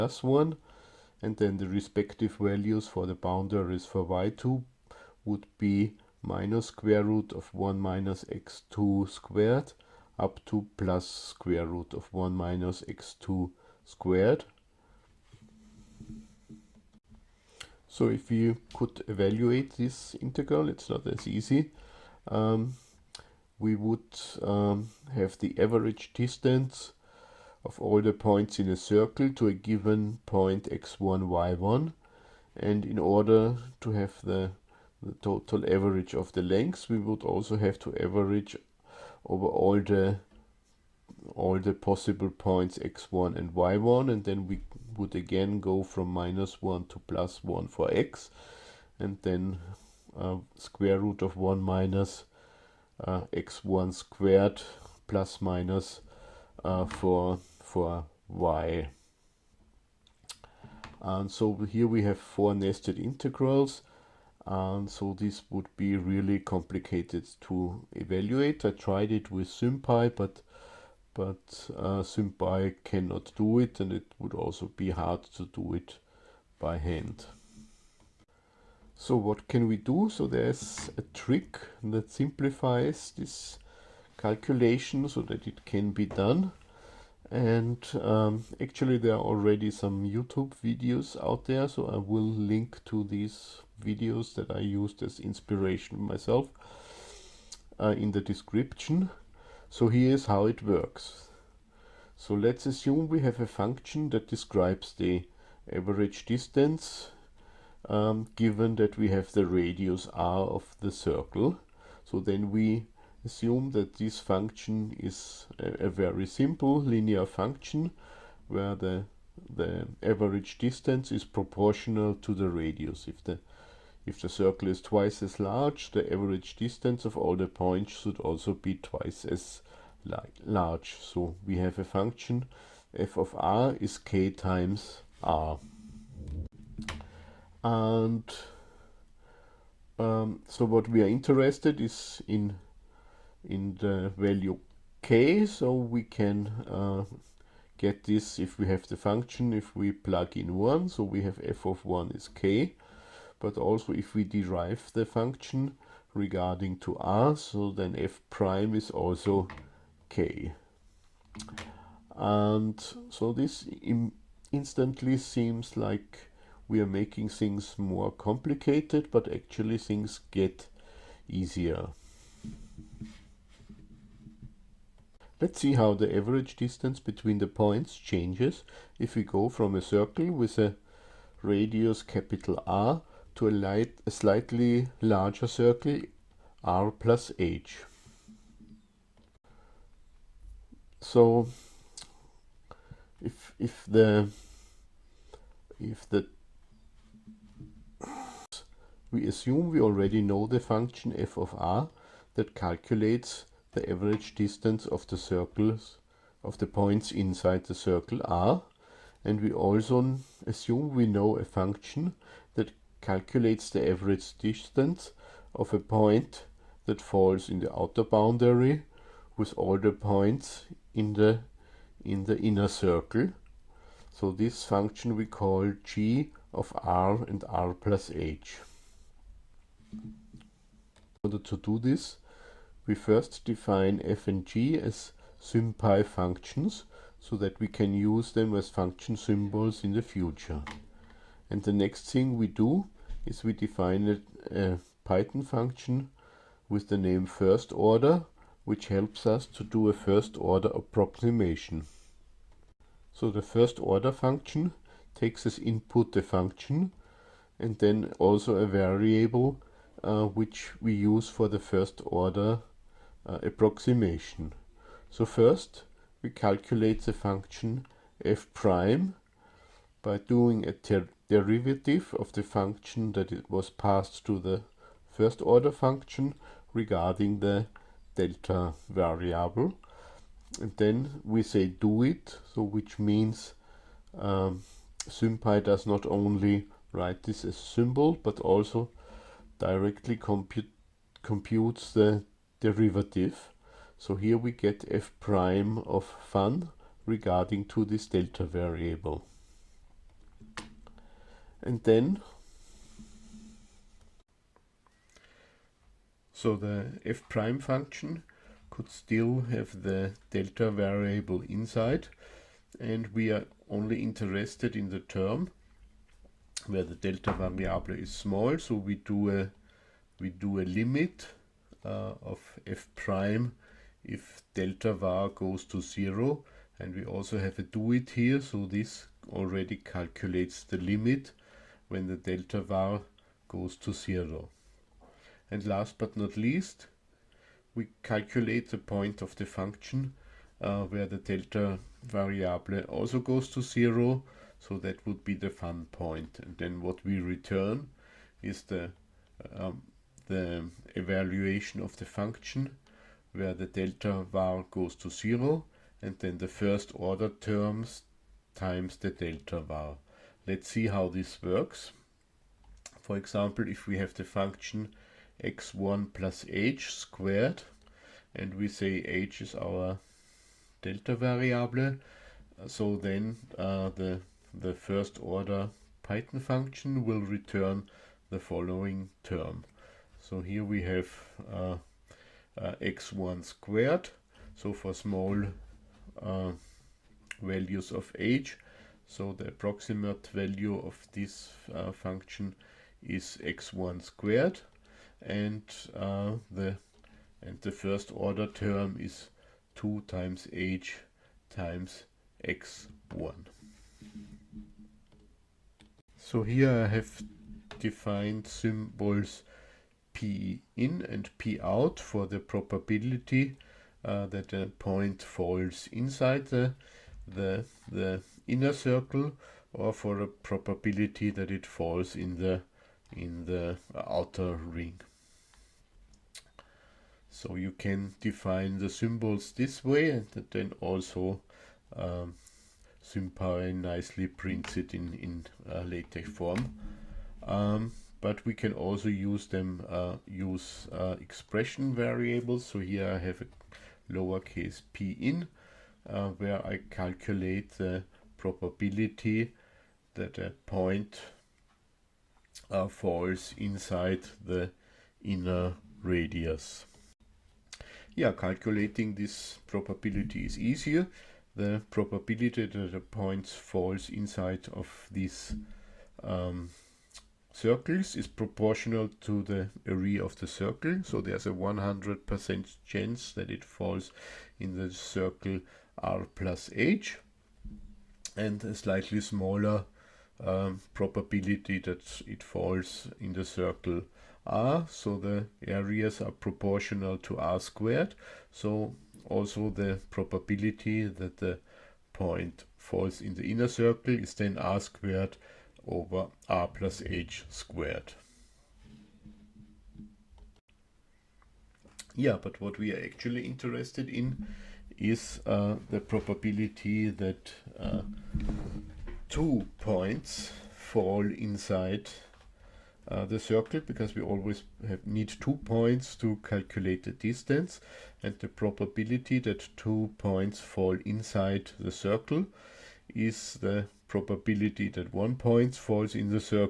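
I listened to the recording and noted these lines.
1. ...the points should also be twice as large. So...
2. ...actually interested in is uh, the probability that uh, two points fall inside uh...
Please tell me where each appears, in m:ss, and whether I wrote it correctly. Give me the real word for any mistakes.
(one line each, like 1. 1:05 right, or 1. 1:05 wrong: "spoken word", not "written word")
1. 2:07 right
2. 8:23 right.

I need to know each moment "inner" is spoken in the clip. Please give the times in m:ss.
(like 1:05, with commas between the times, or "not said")
3:42, 6:58, 7:35, 8:13.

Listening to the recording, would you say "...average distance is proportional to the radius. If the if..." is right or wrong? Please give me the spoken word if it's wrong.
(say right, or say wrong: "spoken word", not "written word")
right.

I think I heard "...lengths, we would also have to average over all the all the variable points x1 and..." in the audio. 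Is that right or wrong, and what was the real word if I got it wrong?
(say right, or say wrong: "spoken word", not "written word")
wrong: "possible", not "variable".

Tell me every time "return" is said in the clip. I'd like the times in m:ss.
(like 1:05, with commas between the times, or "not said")
5:47, 6:17.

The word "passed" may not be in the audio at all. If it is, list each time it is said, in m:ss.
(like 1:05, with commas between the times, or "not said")
4:33.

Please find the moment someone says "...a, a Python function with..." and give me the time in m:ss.
4:04.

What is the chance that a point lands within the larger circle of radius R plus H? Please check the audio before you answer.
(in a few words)
100%.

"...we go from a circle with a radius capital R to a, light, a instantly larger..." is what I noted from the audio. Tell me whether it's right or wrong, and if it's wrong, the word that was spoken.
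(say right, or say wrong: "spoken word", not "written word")
wrong: "slightly", not "instantly".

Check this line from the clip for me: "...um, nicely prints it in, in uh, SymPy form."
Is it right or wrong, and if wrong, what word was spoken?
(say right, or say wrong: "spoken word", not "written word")
wrong: "LaTeX", not "SymPy".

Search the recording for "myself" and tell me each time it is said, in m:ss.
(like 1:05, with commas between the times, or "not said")
1:36.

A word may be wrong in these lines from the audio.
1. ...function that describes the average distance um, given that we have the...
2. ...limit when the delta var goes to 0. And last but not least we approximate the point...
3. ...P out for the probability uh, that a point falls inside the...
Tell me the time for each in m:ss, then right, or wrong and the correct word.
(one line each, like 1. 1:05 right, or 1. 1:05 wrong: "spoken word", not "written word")
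1. 1:43 right
2. 5:30 wrong: "calculate", not "approximate"
3. 6:51 right.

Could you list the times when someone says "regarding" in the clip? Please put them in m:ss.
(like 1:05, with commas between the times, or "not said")
2:36, 4:36, 4:57.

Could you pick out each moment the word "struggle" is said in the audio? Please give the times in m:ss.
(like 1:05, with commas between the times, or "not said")
not said.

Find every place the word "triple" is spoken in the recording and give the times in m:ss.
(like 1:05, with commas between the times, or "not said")
not said.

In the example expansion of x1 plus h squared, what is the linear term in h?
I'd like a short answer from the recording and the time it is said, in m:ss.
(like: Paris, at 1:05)
2 times h times x1, at 6:39.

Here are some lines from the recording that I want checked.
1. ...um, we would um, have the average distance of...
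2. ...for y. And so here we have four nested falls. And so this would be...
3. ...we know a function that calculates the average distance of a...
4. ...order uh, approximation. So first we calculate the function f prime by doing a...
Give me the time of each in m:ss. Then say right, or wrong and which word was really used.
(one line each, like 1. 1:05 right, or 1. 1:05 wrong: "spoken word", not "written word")
1. 0:22 right
2. 0:57 wrong: "integrals", not "falls"
3. 3:30 right
4. 4:22 right.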